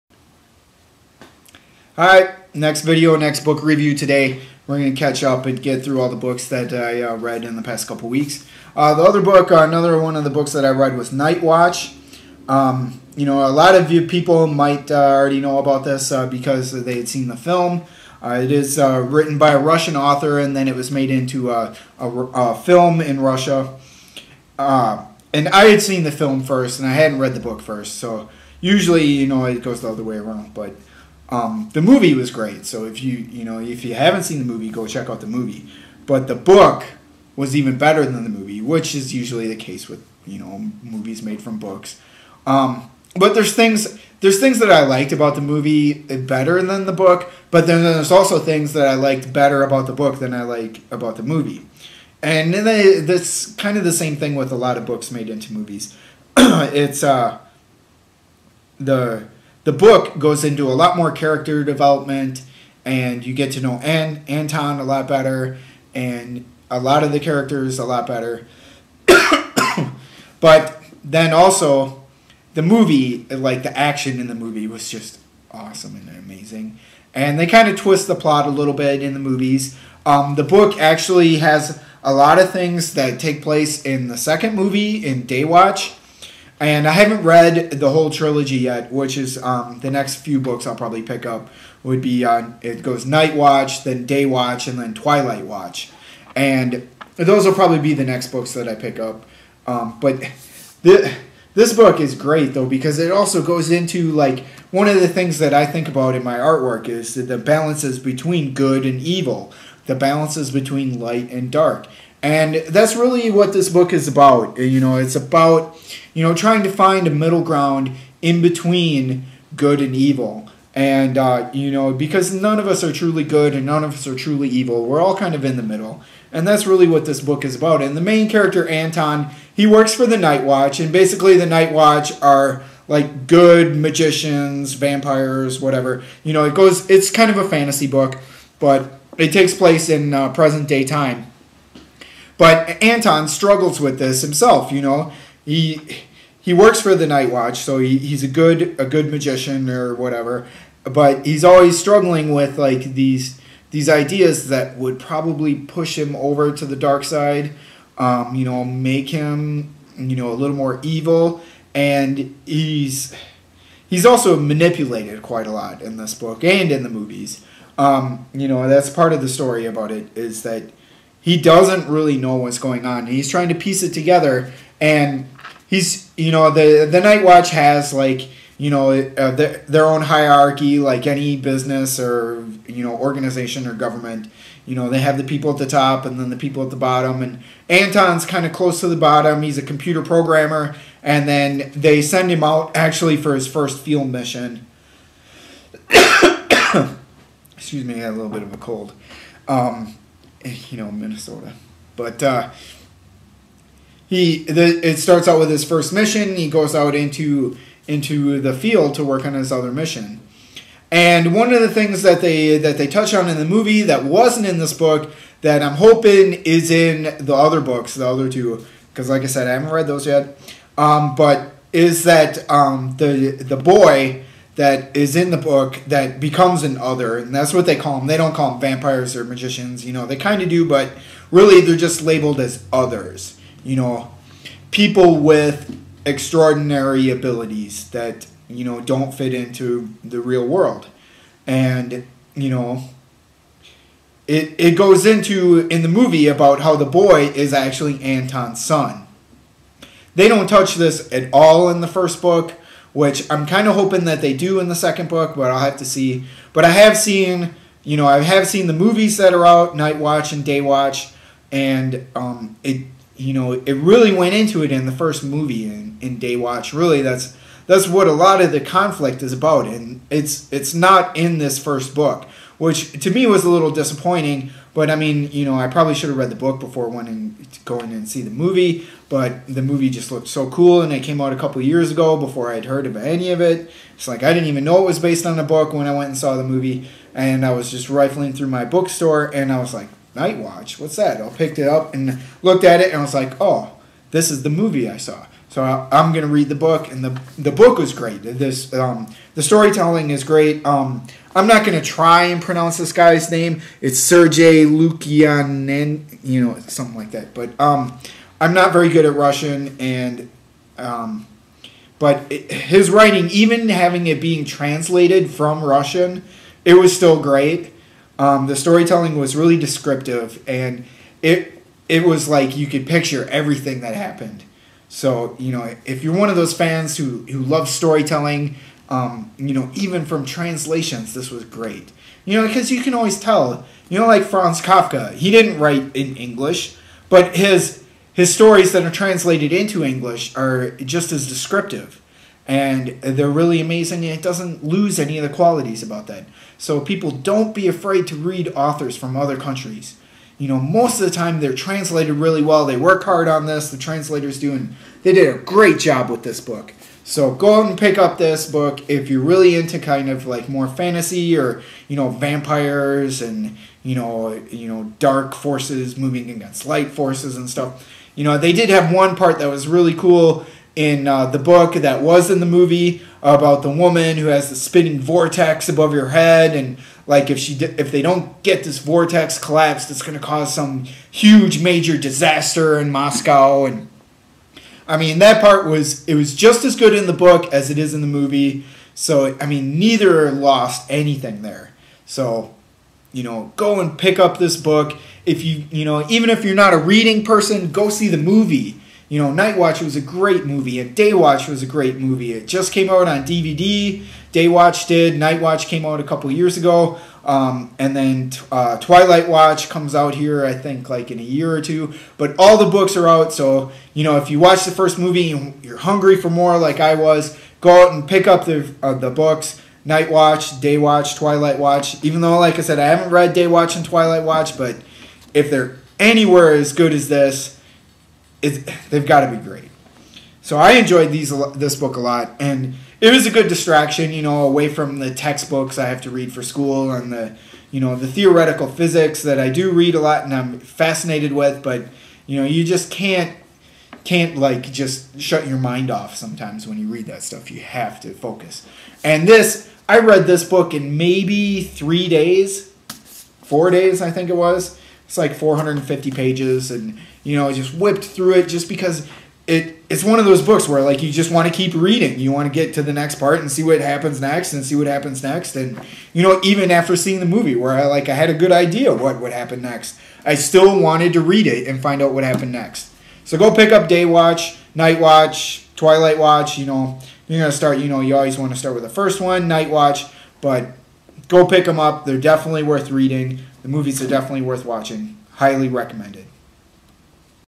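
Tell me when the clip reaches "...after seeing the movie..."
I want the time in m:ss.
7:46.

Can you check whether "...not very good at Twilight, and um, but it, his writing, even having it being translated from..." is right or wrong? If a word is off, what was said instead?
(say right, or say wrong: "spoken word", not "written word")
wrong: "Russian", not "Twilight".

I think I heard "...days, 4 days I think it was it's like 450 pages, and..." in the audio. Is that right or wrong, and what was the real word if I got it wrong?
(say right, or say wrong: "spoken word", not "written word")
right.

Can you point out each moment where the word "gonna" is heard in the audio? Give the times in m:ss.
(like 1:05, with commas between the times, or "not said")
4:56, 5:01.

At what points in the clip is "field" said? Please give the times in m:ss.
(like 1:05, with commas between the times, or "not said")
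3:13, 3:28.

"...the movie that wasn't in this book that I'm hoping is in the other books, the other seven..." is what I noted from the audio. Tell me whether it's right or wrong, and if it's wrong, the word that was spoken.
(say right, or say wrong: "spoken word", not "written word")
wrong: "two", not "seven".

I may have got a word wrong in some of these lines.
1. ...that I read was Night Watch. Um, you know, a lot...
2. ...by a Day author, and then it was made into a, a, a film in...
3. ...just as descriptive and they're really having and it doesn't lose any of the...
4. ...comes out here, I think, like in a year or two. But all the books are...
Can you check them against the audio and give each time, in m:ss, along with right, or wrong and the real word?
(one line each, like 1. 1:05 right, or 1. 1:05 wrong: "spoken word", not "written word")
1. 0:10 right
2. 0:19 wrong: "Russian", not "Day"
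3. 5:40 wrong: "amazing", not "having"
4. 6:49 right.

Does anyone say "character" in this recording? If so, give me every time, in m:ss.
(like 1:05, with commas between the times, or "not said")
1:01, 1:07, 2:08.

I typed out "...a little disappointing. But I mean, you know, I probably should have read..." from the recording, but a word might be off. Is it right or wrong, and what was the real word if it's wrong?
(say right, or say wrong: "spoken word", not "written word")
right.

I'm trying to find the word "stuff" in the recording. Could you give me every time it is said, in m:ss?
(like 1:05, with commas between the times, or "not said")
6:07, 7:27.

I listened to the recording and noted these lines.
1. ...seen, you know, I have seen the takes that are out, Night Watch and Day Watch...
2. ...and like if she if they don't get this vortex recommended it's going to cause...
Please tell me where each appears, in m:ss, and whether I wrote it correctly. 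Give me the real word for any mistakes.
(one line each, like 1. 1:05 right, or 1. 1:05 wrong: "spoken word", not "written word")
1. 4:16 wrong: "movies", not "takes"
2. 6:16 wrong: "collapsed", not "recommended".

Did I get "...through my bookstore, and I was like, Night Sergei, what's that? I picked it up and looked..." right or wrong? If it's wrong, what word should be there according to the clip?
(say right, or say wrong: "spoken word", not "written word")
wrong: "Watch", not "Sergei".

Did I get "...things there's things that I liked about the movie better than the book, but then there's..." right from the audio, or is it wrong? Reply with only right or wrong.
right.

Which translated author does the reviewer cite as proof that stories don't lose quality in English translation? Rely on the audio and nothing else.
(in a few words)
Franz Kafka.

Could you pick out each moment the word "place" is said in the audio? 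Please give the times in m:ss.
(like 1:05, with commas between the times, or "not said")
1:23, 2:19.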